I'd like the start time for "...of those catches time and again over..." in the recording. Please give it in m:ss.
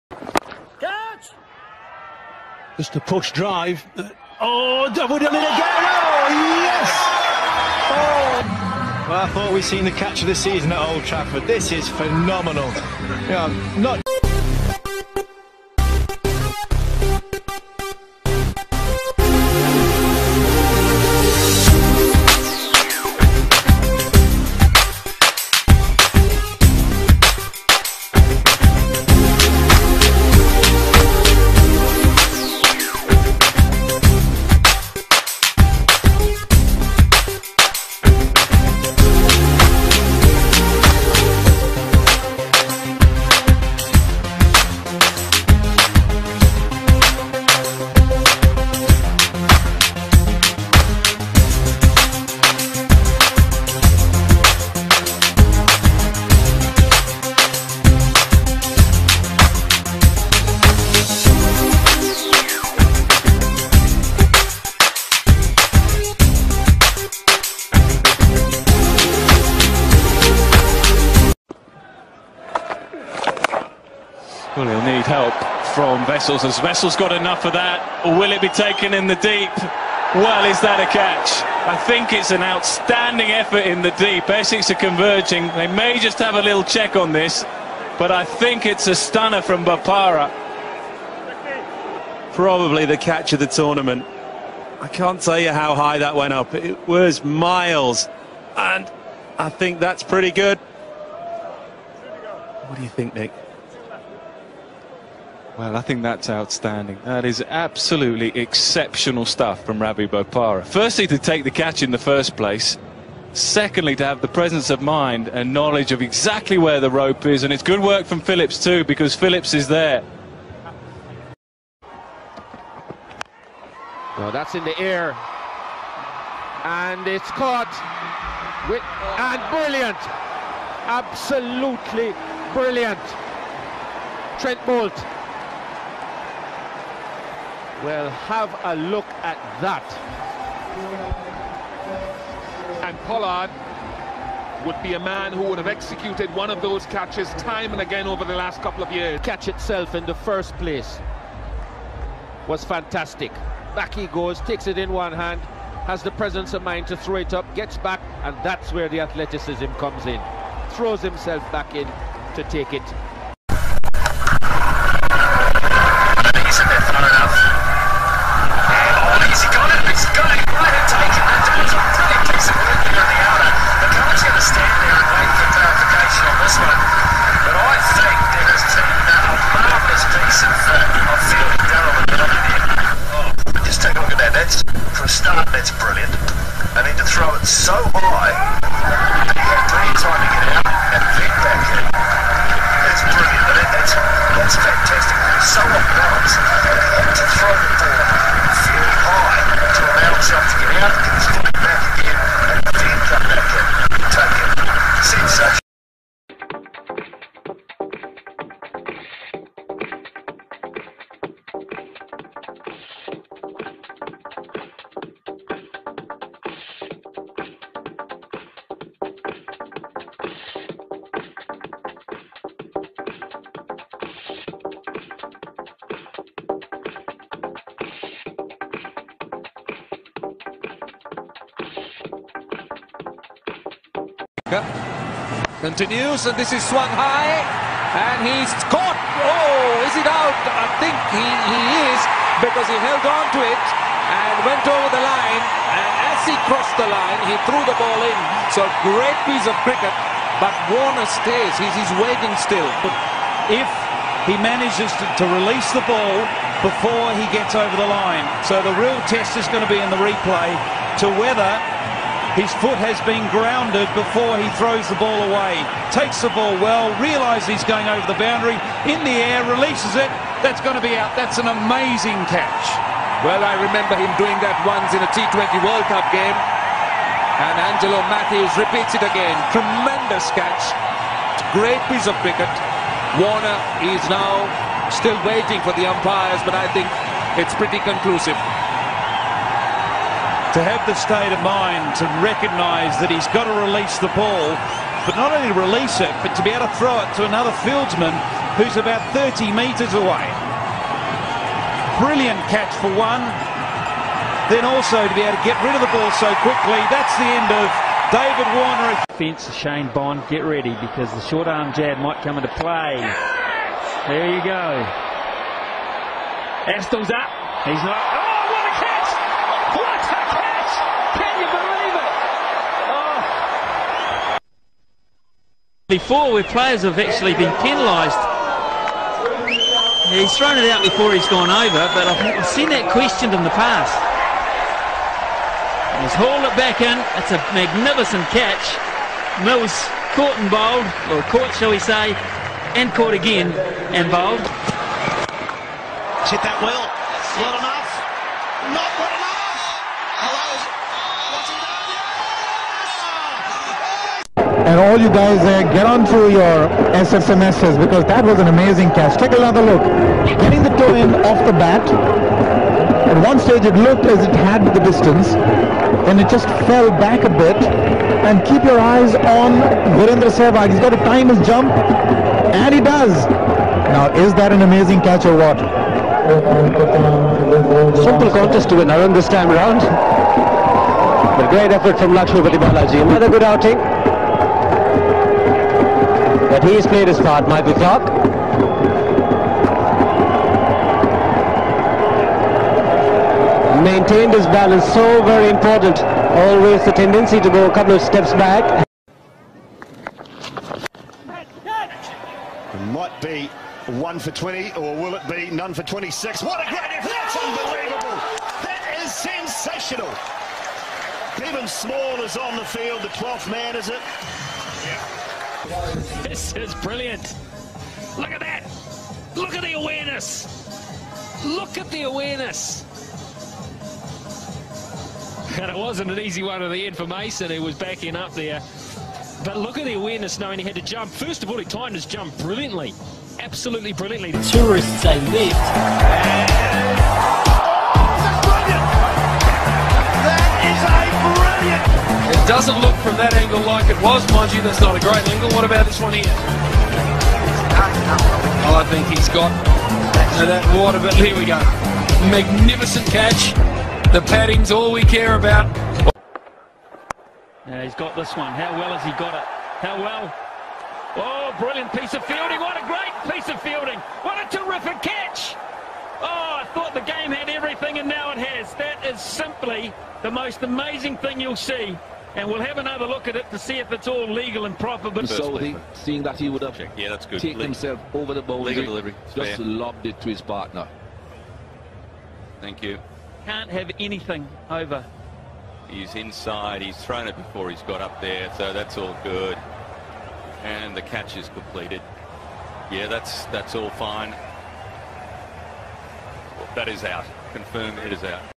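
2:26.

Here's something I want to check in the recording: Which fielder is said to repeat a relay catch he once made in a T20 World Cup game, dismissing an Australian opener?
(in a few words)
Angelo Mathews.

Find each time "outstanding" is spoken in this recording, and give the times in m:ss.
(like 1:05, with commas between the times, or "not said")
1:22, 1:46.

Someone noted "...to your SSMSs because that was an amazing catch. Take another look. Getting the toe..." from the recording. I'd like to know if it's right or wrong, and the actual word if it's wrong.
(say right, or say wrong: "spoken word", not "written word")
right.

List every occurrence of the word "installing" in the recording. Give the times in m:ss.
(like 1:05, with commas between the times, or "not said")
not said.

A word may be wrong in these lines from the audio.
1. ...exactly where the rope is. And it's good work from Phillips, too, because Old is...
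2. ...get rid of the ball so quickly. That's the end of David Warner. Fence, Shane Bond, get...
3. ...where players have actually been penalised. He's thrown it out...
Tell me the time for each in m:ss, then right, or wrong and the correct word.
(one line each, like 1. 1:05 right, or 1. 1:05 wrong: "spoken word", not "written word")
1. 1:56 wrong: "Phillips", not "Old"
2. 5:05 right
3. 5:26 right.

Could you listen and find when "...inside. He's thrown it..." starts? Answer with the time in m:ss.
8:06.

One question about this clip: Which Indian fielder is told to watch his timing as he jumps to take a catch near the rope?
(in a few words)
Virendra Sehwag.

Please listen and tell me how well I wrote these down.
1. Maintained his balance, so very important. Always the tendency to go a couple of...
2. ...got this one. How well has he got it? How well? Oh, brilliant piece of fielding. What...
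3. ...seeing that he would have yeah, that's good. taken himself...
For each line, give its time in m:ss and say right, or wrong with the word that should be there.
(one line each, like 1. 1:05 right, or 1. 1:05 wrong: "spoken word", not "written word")
1. 6:33 right
2. 7:37 right
3. 7:55 right.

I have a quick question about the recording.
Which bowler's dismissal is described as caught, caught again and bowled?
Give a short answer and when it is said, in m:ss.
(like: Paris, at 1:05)
Mills, at 5:39.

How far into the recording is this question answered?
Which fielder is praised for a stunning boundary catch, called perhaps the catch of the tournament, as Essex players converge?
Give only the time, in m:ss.
1:49.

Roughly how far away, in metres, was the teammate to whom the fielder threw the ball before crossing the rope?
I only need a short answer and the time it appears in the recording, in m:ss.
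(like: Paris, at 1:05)
30 metres, at 4:59.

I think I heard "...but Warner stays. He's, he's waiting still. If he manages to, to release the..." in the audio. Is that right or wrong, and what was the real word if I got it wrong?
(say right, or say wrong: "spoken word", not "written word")
right.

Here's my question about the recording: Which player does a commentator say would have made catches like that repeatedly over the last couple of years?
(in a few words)
Pollard.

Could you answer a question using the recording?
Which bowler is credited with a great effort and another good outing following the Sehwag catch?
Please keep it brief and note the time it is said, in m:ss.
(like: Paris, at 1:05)
Lakshmi Balaji, at 6:22.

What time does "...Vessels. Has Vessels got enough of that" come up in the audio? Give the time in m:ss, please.
1:16.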